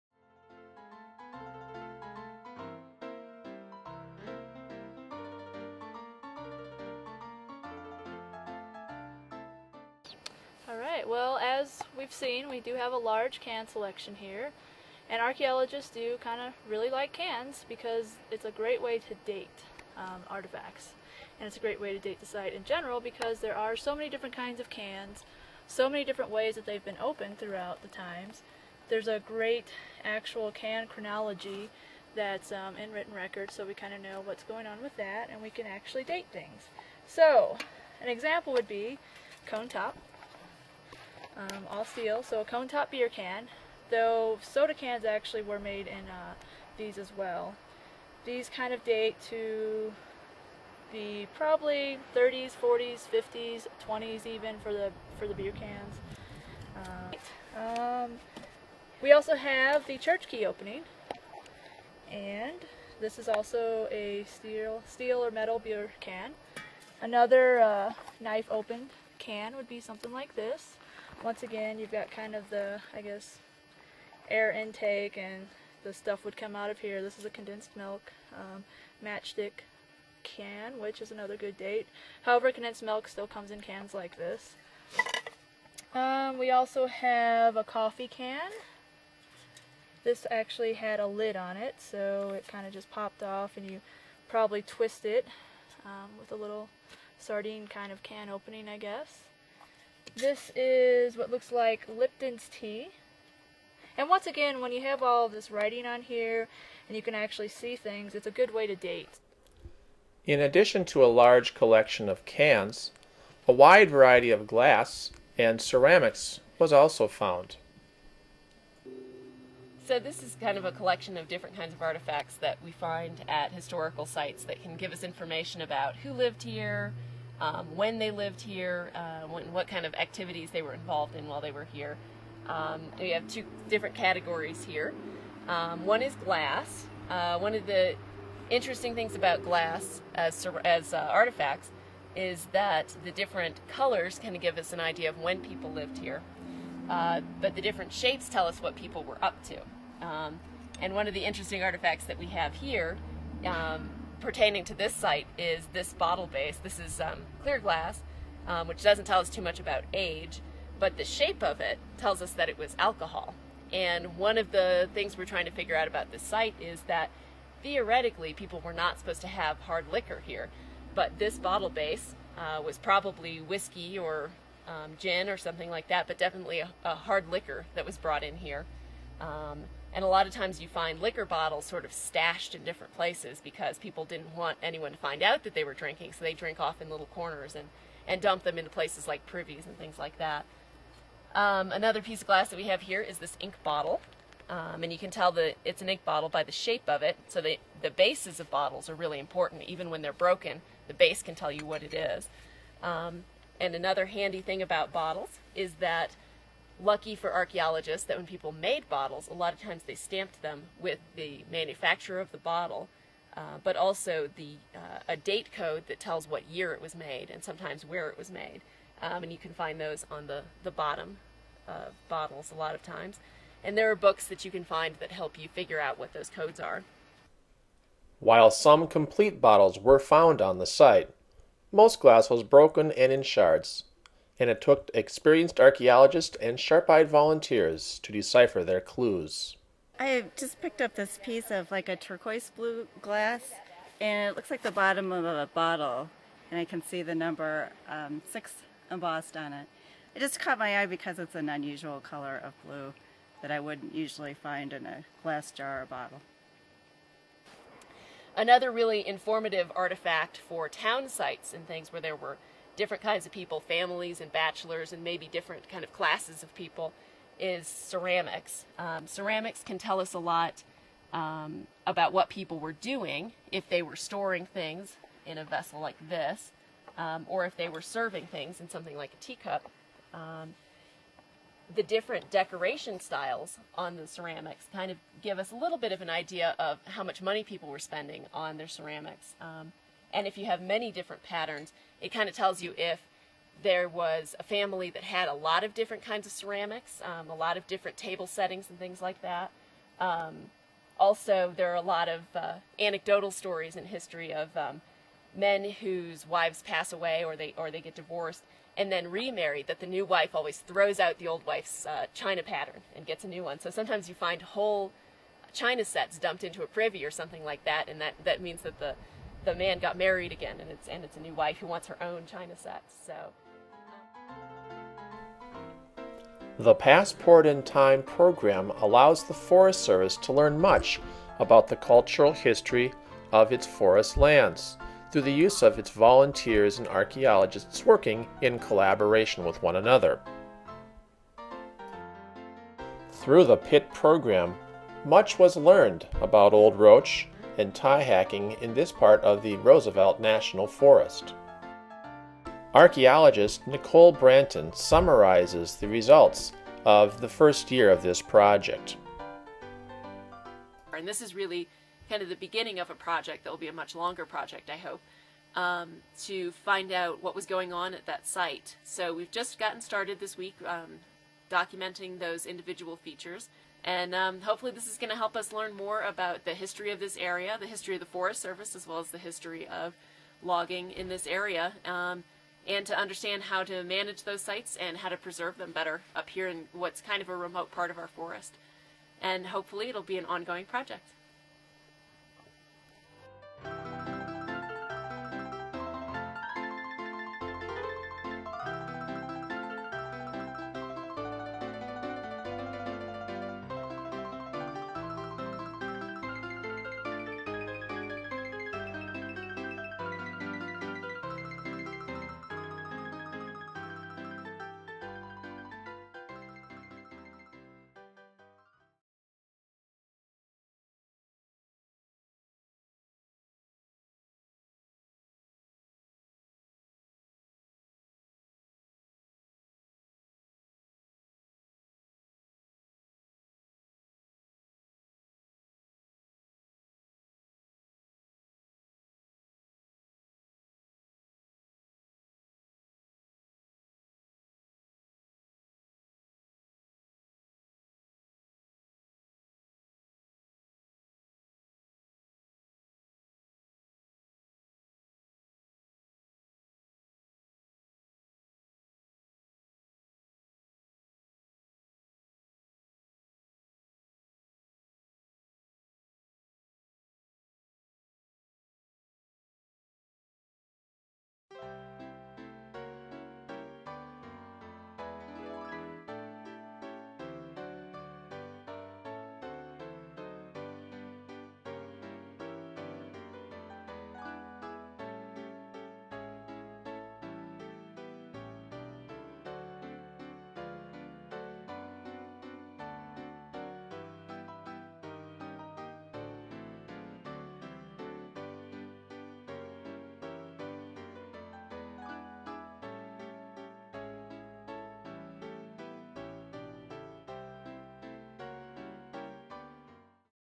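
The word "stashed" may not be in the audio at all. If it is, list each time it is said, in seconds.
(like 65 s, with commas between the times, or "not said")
181 s.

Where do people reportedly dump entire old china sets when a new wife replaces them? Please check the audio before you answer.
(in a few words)
A privy.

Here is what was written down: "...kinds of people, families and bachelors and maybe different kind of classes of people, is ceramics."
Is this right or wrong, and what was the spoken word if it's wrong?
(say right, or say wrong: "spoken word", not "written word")
right.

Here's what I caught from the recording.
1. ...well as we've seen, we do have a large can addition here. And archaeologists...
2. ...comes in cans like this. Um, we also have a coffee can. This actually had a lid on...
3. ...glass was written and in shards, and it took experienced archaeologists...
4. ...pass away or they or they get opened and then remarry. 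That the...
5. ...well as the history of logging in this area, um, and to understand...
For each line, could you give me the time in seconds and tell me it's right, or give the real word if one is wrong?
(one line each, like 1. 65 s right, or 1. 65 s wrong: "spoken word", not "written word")
1. 11 s wrong: "selection", not "addition"
2. 83 s right
3. 231 s wrong: "broken", not "written"
4. 306 s wrong: "divorced", not "opened"
5. 378 s right.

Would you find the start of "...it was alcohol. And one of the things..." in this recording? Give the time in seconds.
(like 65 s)
162 s.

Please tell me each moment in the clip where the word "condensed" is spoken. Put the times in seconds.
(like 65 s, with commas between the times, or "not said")
77 s, 82 s.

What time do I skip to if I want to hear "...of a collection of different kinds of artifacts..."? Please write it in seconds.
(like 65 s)
120 s.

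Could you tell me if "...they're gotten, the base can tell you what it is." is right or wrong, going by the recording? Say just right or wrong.
wrong.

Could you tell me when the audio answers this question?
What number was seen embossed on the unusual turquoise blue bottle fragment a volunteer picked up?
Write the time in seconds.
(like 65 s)
248 s.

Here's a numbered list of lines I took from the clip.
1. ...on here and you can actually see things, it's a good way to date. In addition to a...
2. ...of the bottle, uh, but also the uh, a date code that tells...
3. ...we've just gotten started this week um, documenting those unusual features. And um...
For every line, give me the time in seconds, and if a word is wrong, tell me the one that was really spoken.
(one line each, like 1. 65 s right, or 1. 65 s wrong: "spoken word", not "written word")
1. 105 s right
2. 212 s right
3. 369 s wrong: "individual", not "unusual".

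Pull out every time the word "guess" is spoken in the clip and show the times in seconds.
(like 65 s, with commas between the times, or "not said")
73 s, 98 s.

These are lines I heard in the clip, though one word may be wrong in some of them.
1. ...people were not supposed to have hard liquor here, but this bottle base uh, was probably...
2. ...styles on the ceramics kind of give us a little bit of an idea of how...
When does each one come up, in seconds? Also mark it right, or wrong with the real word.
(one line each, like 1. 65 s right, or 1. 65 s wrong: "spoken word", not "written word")
1. 168 s right
2. 282 s right.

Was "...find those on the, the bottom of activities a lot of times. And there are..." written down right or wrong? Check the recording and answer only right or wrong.
wrong.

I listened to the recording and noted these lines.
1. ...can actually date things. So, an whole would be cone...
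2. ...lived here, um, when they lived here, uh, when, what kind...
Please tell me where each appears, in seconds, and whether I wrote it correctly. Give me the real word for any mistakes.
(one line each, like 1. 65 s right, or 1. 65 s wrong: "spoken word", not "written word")
1. 35 s wrong: "example", not "whole"
2. 126 s right.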